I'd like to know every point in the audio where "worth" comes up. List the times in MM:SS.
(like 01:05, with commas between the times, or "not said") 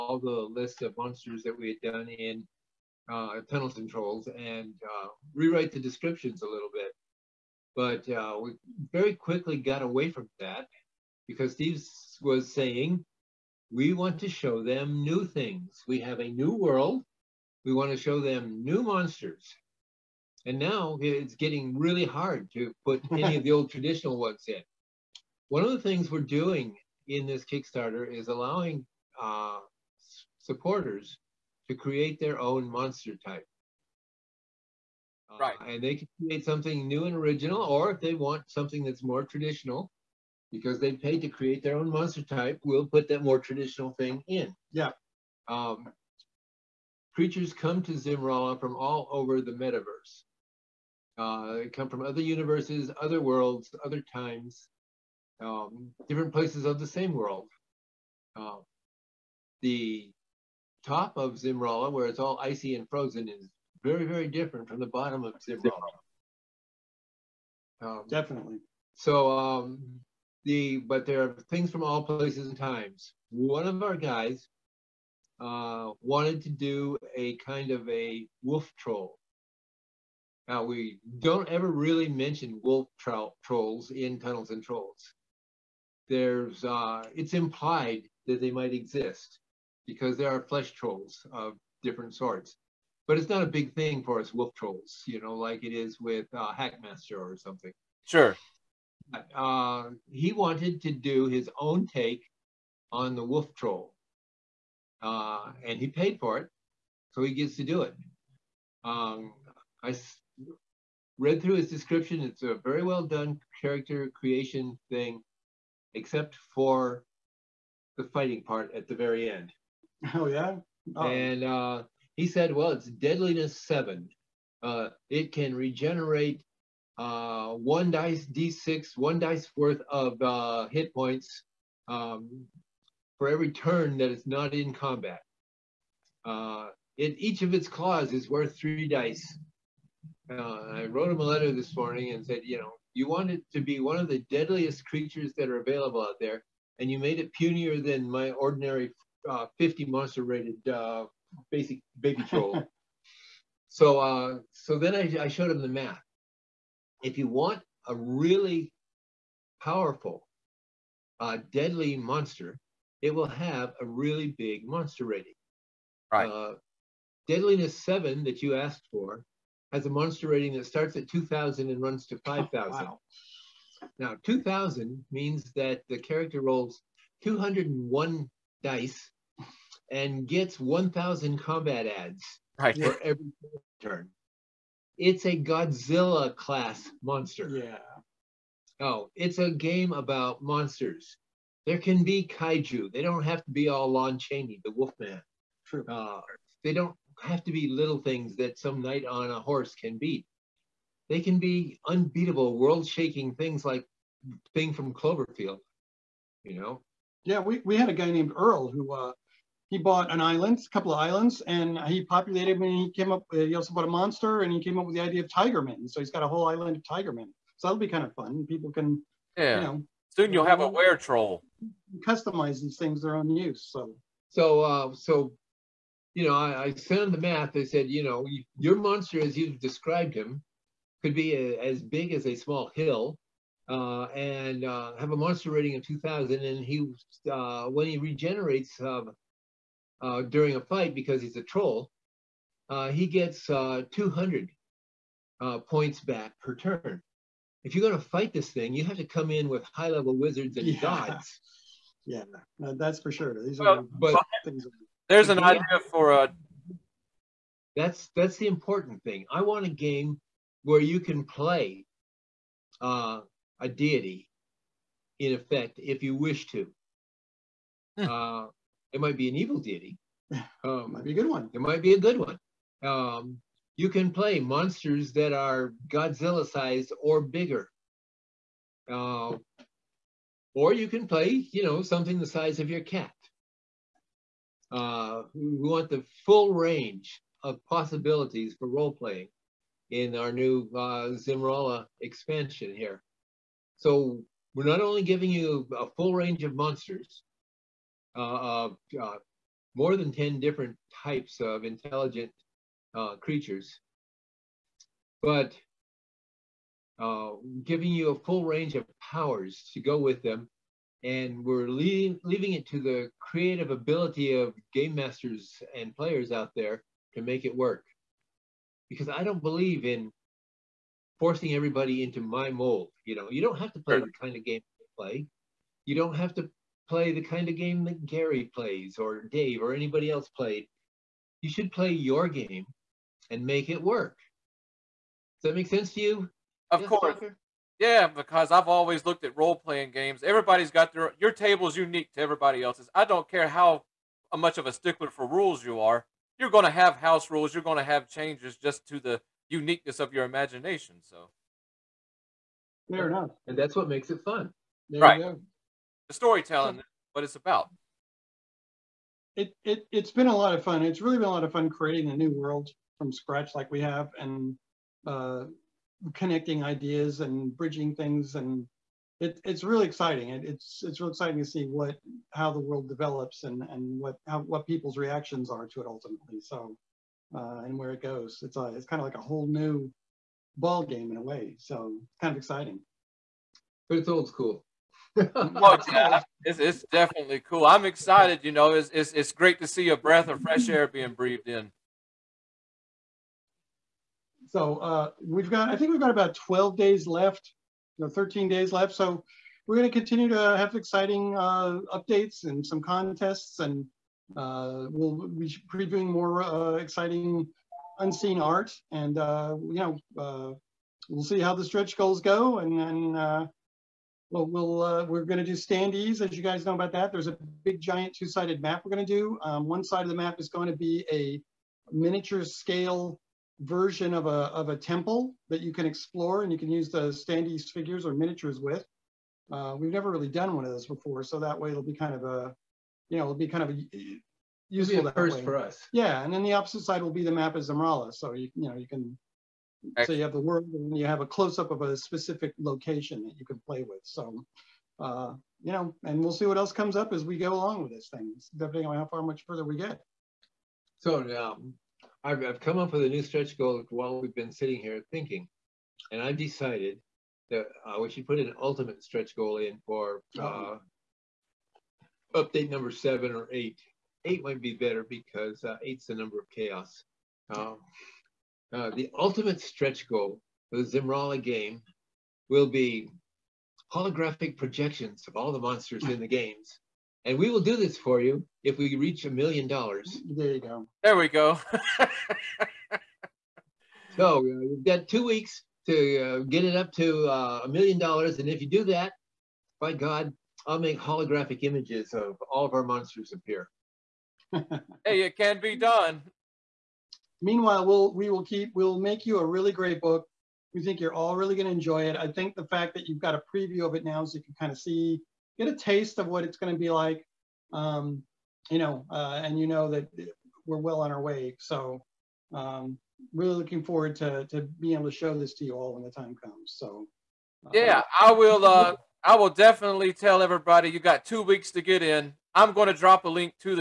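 02:09, 02:18.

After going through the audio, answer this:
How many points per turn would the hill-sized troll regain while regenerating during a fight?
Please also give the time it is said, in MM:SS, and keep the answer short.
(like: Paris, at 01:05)
200, at 04:03.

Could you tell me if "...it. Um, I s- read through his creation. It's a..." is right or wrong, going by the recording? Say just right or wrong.
wrong.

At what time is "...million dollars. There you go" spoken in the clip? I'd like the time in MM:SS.
07:59.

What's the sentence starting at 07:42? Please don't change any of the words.
uh, update number seven or eight.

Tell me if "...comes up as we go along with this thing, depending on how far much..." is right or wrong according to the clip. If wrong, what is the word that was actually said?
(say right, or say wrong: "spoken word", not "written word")
right.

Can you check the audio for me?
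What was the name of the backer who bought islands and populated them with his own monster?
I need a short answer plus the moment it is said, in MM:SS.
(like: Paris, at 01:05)
Earl, at 03:28.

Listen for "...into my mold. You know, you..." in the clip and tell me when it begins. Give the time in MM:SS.
05:22.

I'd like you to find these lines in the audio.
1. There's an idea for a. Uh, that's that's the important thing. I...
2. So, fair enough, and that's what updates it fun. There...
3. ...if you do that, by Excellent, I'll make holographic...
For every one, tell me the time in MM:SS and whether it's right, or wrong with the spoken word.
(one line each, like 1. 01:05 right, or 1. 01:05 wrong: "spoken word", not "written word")
1. 04:15 right
2. 05:51 wrong: "makes", not "updates"
3. 08:08 wrong: "God", not "Excellent".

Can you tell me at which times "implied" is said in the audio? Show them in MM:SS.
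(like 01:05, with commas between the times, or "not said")
01:27.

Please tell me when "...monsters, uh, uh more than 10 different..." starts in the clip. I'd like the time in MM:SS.
04:56.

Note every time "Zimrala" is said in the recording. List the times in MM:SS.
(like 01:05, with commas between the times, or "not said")
00:47, 01:01, 01:05, 07:17, 07:50.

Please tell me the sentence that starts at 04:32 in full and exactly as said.
Um, you can play monsters that are Godzilla sized or bigger.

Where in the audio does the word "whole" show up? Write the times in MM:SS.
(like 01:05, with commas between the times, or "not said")
03:36, 06:19.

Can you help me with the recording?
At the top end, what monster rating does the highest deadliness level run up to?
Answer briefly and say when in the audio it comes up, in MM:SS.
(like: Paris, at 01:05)
5,000, at 02:52.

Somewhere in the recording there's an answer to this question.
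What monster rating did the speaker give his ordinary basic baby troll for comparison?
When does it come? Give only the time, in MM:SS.
02:29.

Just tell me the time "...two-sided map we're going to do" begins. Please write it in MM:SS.
06:58.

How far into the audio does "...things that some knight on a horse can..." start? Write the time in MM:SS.
03:17.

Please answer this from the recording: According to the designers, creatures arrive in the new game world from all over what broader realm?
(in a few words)
the metaverse.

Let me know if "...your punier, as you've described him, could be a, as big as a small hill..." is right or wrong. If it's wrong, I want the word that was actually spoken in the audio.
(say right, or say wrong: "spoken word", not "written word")
wrong: "monster", not "punier".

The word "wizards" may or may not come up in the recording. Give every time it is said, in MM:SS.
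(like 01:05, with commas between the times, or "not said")
04:10.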